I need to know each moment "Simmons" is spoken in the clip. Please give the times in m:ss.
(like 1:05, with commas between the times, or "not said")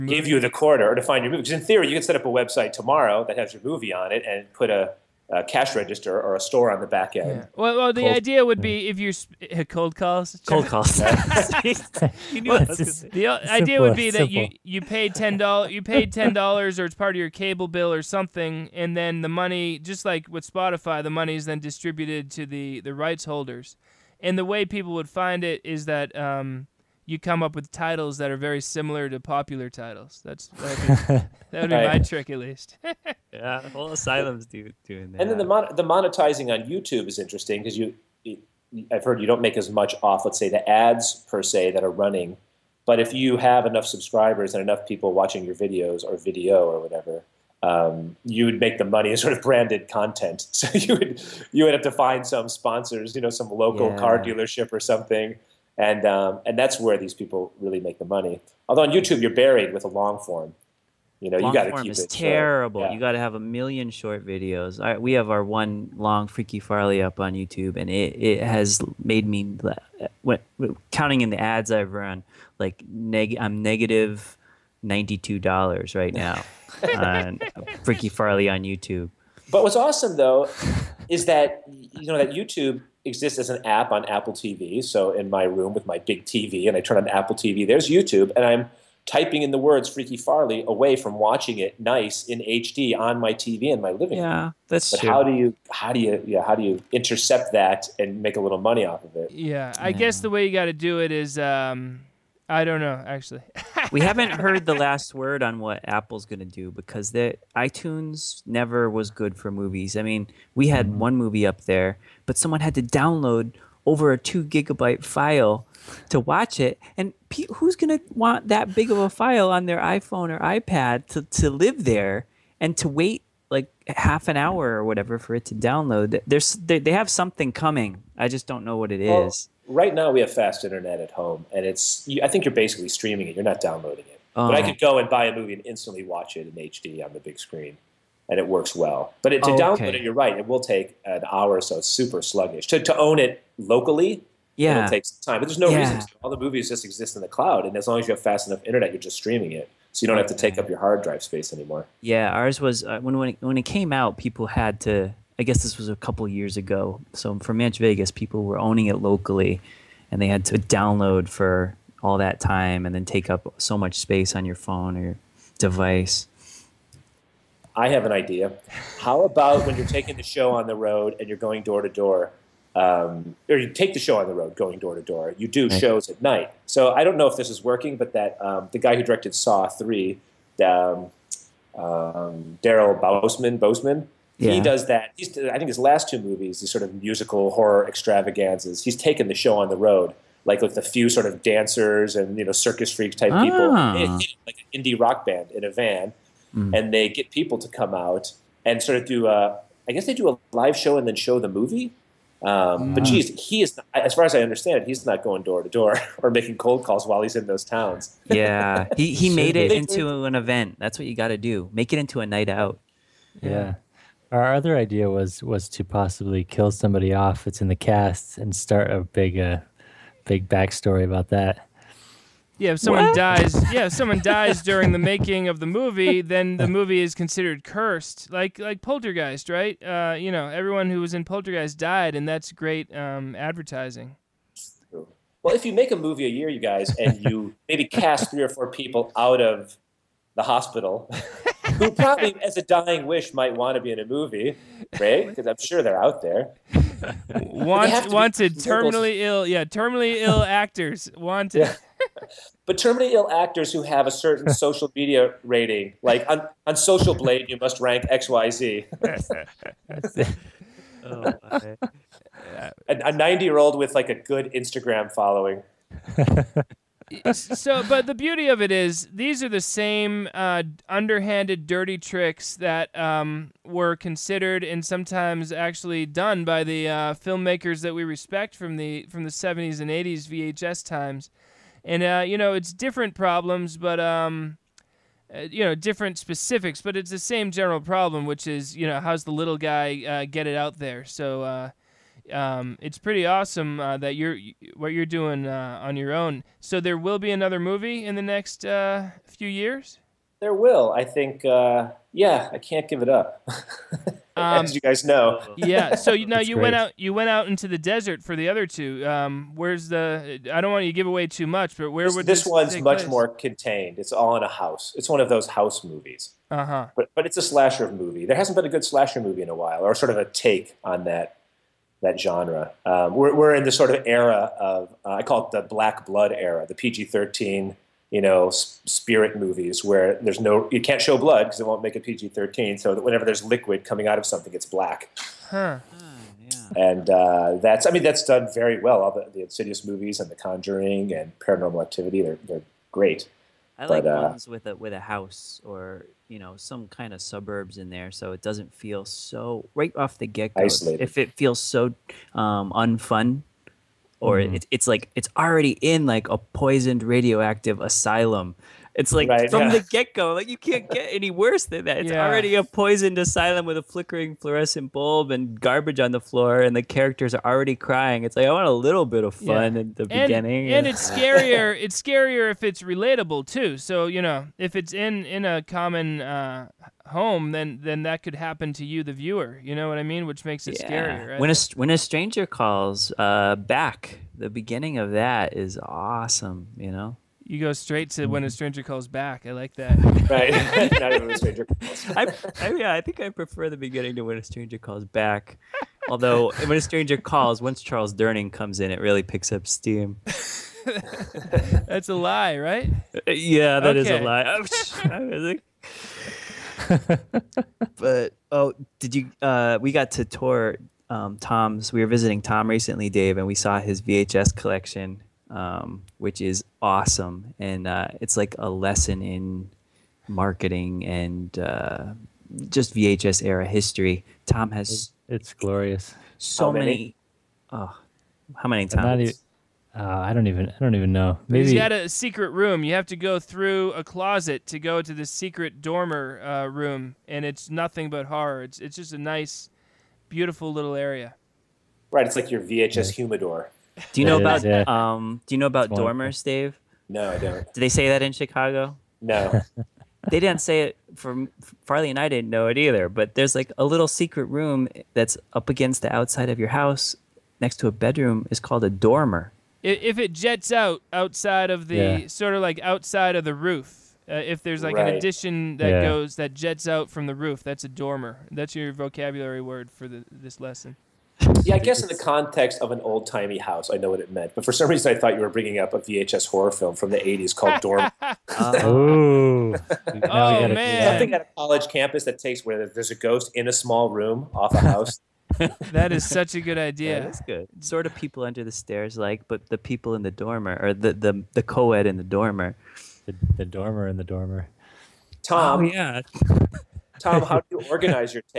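not said.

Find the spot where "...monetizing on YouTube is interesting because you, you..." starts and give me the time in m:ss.
0:35.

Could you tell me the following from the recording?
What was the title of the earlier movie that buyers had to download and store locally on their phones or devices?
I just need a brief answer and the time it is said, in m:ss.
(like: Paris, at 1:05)
Manchvegas, at 2:37.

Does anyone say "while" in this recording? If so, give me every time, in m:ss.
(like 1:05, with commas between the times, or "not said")
3:27, 5:19.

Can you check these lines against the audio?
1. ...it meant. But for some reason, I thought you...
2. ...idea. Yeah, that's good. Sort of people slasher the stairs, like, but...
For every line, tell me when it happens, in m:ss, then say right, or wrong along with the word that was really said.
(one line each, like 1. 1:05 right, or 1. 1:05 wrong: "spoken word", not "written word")
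1. 7:54 right
2. 8:06 wrong: "under", not "slasher".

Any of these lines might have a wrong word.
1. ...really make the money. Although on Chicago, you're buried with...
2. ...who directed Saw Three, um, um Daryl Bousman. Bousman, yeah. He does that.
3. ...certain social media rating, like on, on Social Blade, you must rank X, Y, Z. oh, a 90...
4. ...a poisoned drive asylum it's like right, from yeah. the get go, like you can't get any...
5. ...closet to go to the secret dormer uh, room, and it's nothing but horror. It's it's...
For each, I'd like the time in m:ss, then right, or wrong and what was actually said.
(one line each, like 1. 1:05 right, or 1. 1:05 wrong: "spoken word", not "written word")
1. 0:57 wrong: "YouTube", not "Chicago"
2. 2:58 right
3. 4:14 right
4. 5:56 wrong: "radioactive", not "drive"
5. 7:14 right.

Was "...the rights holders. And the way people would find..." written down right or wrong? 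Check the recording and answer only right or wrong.
right.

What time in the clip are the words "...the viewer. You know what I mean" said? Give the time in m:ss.
6:19.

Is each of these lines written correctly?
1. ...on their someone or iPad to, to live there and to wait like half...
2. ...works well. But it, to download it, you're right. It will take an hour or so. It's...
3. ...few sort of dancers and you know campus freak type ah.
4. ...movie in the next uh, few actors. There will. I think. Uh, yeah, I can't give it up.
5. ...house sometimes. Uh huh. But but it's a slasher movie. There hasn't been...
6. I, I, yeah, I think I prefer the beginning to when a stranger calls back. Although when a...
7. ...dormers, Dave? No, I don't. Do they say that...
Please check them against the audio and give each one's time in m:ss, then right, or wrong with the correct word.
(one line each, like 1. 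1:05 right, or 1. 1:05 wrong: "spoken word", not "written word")
1. 1:59 wrong: "iPhone", not "someone"
2. 2:18 right
3. 3:10 wrong: "circus", not "campus"
4. 4:57 wrong: "years", not "actors"
5. 5:15 wrong: "movies", not "sometimes"
6. 6:32 right
7. 7:25 right.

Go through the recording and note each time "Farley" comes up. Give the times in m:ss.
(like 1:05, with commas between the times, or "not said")
1:06, 1:18, 1:30, 7:31.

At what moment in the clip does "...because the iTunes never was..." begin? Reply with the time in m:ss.
1:46.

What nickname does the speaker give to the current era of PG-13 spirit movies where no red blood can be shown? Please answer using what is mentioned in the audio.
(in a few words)
Black Blood era.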